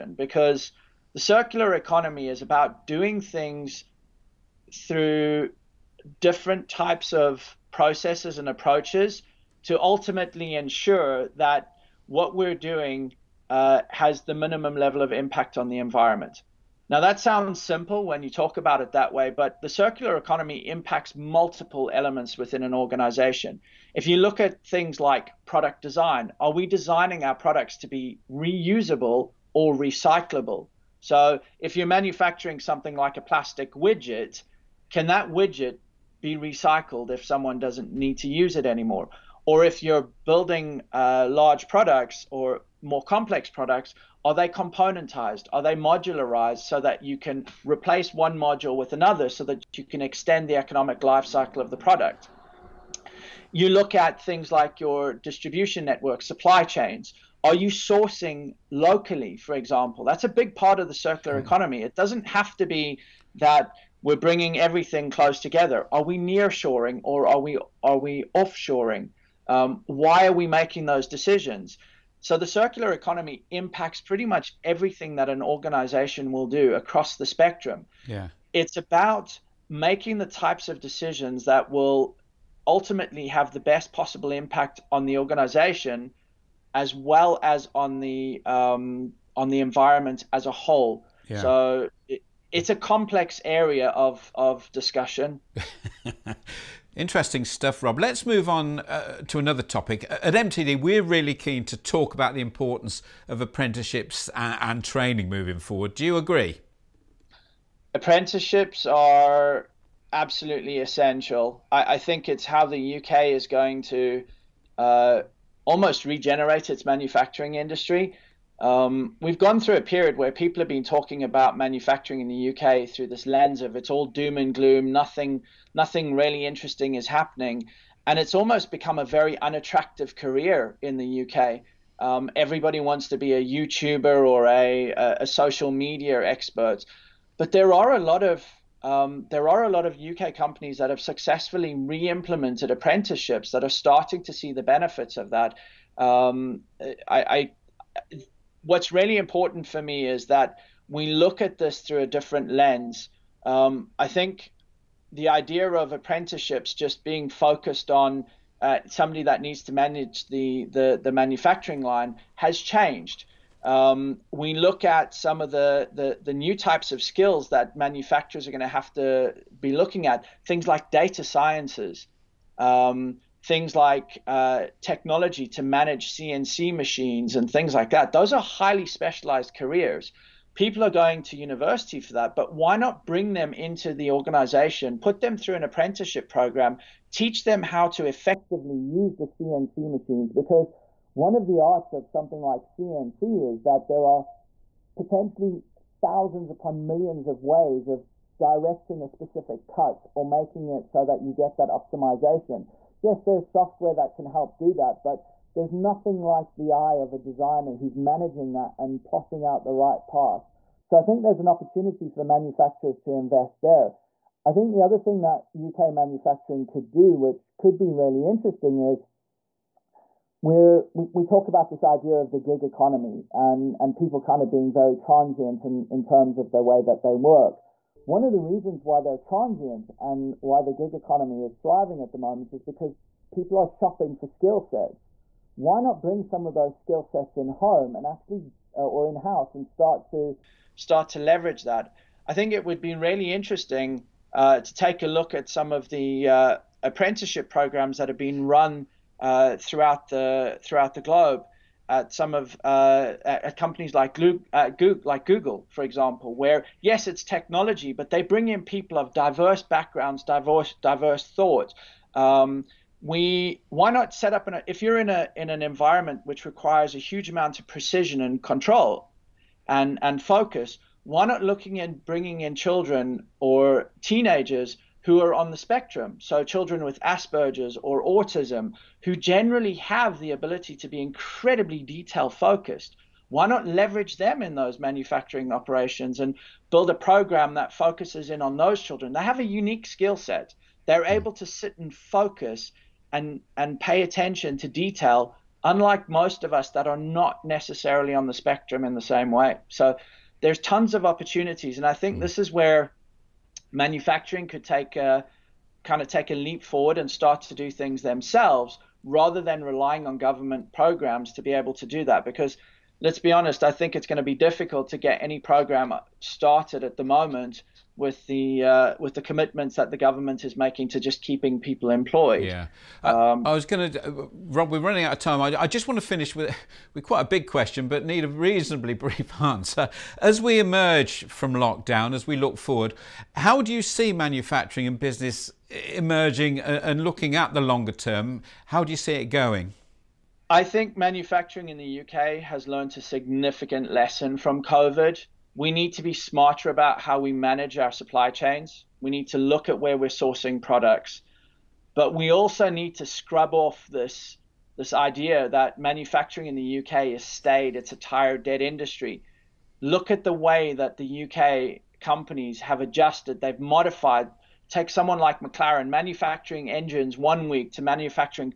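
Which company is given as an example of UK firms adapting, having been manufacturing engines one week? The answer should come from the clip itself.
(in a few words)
McLaren.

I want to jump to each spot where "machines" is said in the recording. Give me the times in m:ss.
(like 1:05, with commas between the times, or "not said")
2:56, 3:09.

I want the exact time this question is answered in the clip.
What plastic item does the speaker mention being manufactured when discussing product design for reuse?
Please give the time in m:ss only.
0:33.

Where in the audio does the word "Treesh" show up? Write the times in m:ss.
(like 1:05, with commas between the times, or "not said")
not said.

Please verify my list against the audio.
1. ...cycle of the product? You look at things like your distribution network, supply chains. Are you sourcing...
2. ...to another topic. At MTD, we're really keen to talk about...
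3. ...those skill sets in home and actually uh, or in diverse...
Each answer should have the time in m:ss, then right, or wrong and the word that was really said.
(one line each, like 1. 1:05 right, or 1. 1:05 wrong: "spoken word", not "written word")
1. 0:51 right
2. 1:39 right
3. 3:56 wrong: "house", not "diverse".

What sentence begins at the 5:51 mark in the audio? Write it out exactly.
But we also need to scrub off this this idea that manufacturing in the UK is staid, it's a tired dead industry.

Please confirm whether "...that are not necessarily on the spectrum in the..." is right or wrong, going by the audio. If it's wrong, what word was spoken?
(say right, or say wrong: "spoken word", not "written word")
right.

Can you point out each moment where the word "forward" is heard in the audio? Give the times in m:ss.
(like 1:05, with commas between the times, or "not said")
1:45, 5:06, 5:32.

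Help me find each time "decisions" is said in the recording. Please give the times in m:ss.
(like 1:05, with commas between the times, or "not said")
1:11, 1:20.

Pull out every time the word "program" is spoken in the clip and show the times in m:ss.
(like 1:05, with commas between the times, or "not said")
3:06, 4:07, 4:46, 5:10, 5:15.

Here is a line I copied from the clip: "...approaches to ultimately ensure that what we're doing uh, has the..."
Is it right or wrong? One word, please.
right.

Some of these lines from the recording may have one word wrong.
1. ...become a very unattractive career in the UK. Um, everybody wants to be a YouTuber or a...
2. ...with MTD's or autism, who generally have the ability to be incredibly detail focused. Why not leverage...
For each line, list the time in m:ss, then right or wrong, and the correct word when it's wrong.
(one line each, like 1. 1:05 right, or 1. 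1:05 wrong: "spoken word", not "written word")
1. 2:08 right
2. 4:36 wrong: "Asperger", not "MTD".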